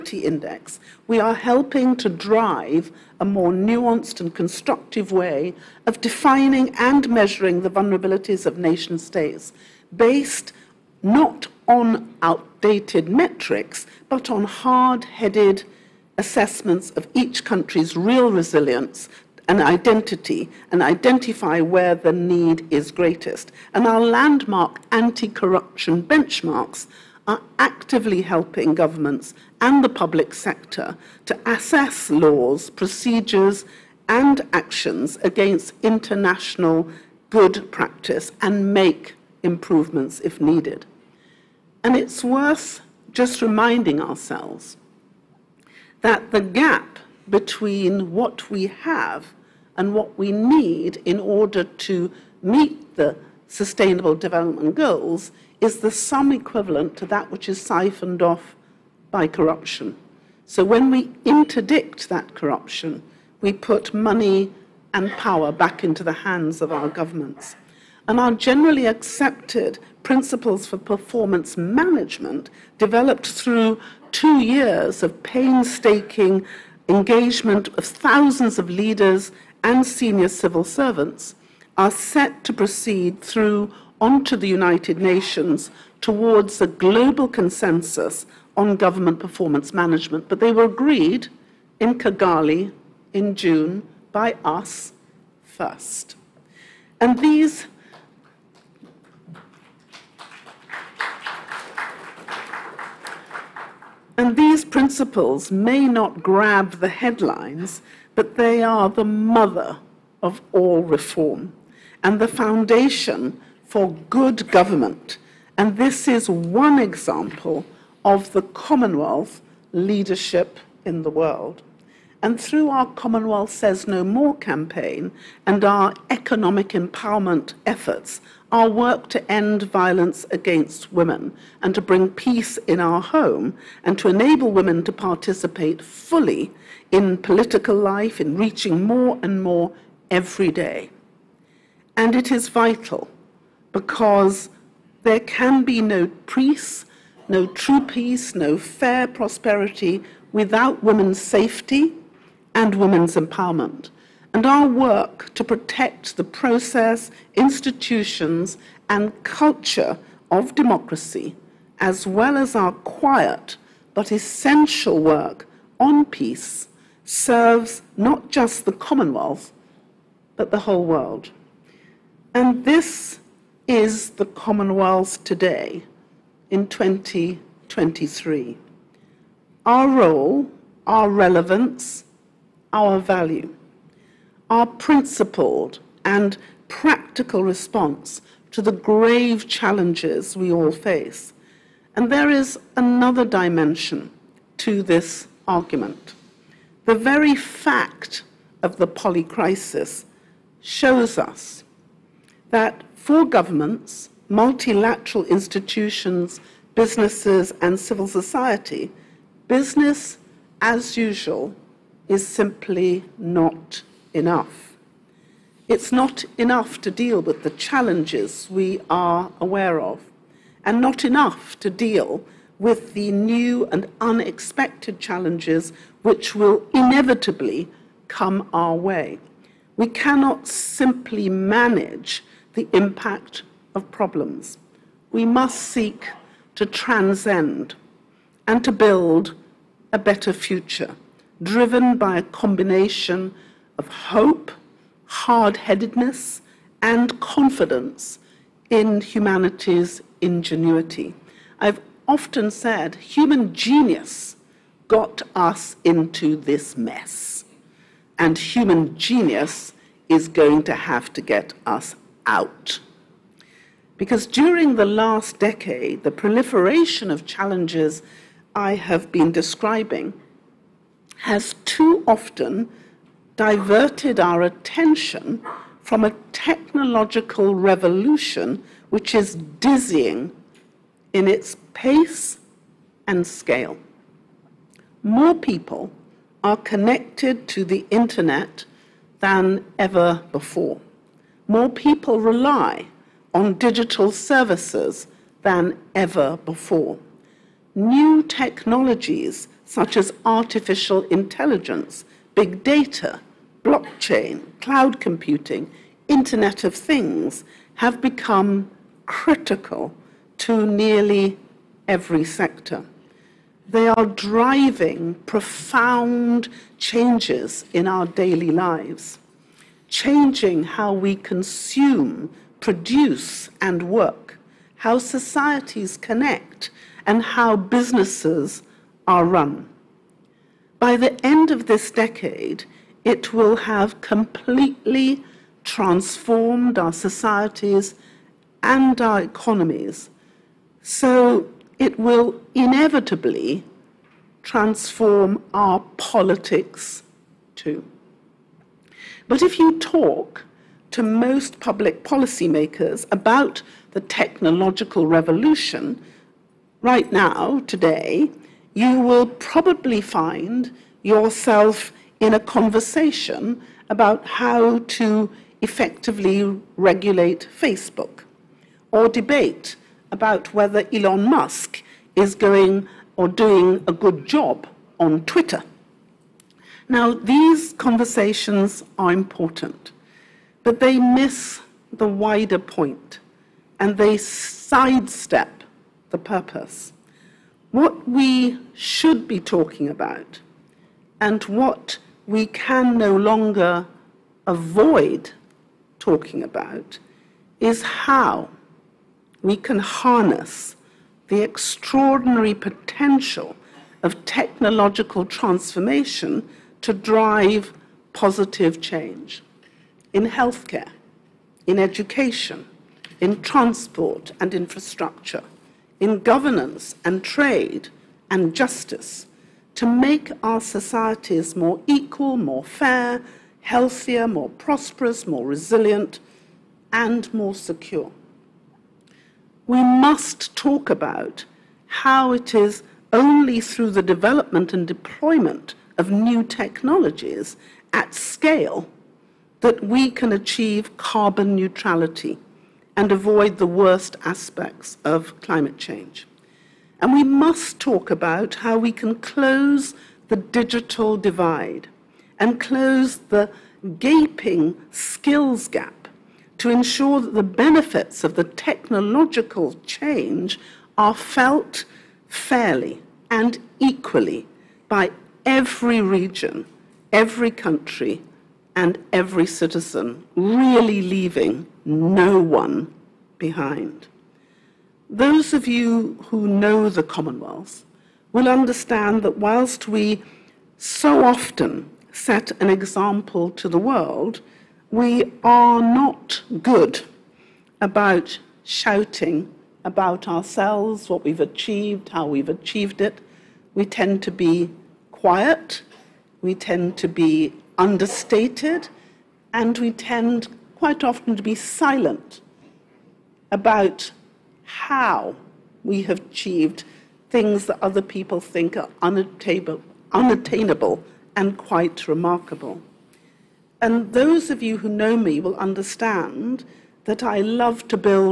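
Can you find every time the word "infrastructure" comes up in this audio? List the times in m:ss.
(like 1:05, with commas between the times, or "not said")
6:54.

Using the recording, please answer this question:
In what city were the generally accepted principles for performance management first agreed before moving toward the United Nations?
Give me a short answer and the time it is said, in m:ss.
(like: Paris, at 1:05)
Kigali, at 1:31.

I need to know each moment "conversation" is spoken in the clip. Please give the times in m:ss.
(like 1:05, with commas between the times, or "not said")
6:02, 6:17.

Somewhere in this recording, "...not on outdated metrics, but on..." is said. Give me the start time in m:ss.
0:11.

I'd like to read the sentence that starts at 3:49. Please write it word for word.
We cannot simply manage the impact of problems.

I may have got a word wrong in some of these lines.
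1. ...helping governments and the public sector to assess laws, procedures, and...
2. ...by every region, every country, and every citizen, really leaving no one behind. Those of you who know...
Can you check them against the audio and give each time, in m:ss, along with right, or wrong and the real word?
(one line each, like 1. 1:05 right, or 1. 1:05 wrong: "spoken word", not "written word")
1. 0:28 right
2. 7:44 right.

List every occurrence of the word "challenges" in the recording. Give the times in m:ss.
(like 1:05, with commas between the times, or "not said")
3:09, 3:37, 3:44, 4:27.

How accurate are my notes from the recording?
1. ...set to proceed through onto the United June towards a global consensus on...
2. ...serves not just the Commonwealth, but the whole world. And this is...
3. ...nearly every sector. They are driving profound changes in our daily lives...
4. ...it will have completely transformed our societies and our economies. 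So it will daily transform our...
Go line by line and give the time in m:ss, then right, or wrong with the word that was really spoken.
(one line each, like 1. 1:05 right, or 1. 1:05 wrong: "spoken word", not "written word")
1. 1:21 wrong: "Nations", not "June"
2. 2:47 right
3. 5:10 right
4. 5:33 wrong: "inevitably", not "daily".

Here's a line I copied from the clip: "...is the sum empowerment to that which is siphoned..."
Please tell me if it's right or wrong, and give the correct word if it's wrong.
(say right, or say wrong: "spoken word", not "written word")
wrong: "equivalent", not "empowerment".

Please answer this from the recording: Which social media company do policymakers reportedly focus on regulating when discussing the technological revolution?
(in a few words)
Facebook.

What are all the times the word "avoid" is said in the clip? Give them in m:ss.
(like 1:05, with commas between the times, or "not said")
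6:34, 7:23.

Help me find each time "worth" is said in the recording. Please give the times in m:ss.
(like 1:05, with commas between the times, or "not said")
0:42.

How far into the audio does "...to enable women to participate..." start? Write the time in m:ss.
2:13.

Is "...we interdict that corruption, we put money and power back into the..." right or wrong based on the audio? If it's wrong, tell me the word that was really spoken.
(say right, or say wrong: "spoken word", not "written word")
right.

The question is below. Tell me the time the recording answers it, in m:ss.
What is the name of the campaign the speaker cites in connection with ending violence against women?
2:02.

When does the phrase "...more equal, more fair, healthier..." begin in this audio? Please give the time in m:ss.
7:01.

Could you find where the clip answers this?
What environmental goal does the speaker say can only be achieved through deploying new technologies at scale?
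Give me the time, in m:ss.
7:20.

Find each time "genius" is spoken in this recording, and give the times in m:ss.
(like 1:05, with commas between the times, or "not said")
4:13, 4:18.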